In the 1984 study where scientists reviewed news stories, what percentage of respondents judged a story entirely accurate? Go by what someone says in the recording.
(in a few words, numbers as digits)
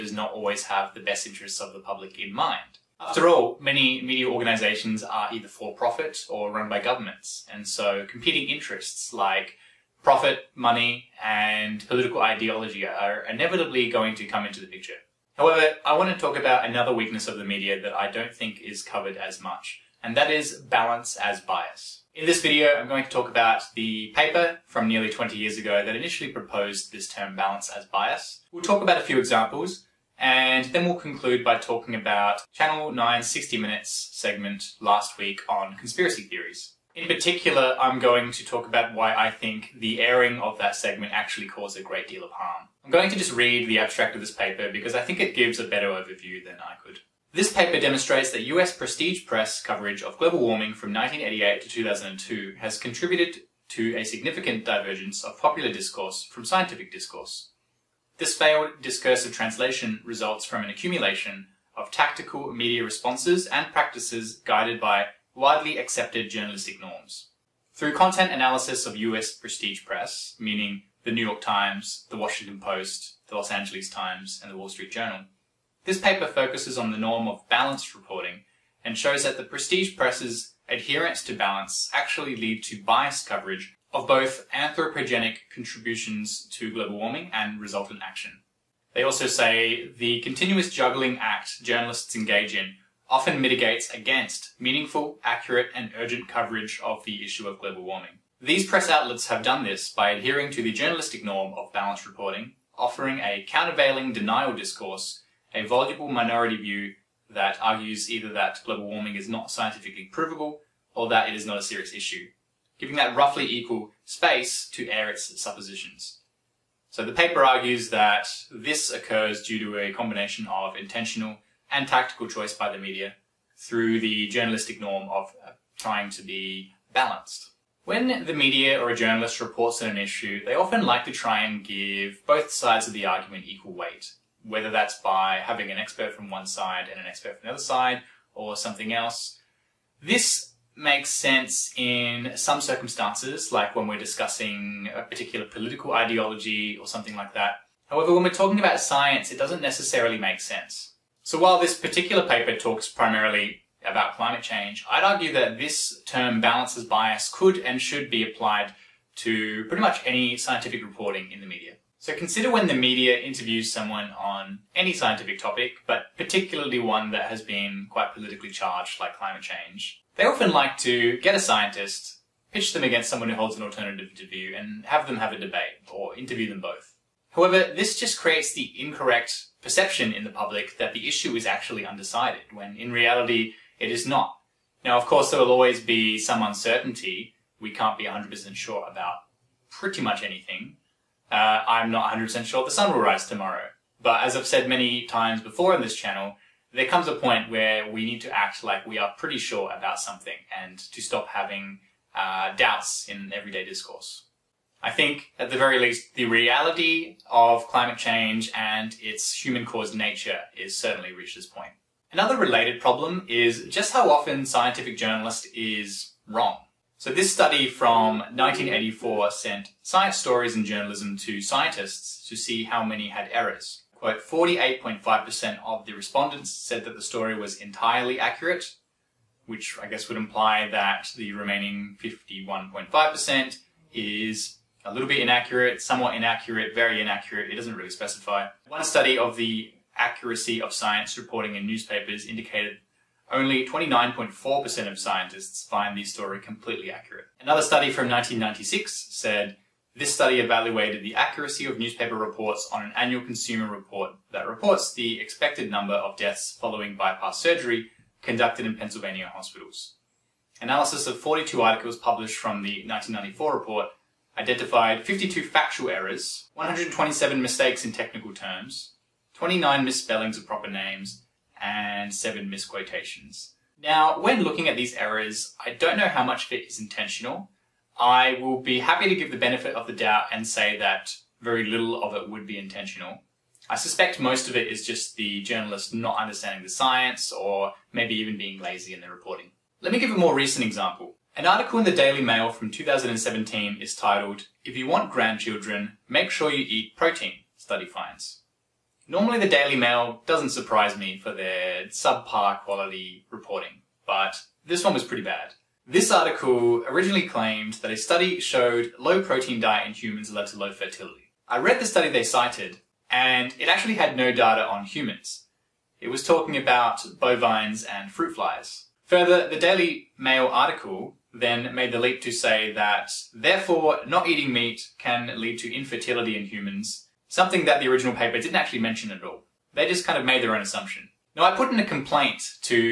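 48.5%.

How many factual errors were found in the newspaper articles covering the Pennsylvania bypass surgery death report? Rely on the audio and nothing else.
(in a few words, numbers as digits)
52.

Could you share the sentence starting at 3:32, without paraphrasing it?
Another related problem is just how often scientific journalist is wrong.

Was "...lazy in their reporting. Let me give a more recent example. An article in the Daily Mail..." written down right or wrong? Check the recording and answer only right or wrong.
right.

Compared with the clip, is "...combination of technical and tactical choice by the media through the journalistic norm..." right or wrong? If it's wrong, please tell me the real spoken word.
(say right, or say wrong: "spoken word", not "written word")
wrong: "intentional", not "technical".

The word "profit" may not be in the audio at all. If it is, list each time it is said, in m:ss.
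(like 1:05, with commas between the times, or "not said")
0:05, 0:10.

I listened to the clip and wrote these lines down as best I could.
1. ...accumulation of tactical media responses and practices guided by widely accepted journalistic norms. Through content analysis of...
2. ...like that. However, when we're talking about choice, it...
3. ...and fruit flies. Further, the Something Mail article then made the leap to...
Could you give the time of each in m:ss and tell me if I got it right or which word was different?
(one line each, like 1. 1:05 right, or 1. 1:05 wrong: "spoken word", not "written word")
1. 1:00 right
2. 2:27 wrong: "science", not "choice"
3. 5:17 wrong: "Daily", not "Something".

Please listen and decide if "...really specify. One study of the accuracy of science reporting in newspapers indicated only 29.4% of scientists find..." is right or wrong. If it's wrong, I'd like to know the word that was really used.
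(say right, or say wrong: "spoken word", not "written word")
right.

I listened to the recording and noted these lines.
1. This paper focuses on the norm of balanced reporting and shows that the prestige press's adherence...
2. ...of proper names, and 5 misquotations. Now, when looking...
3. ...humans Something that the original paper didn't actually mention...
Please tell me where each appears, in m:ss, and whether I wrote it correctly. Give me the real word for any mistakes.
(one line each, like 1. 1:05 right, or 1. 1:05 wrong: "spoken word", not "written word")
1. 1:15 right
2. 4:30 wrong: "7", not "5"
3. 5:26 right.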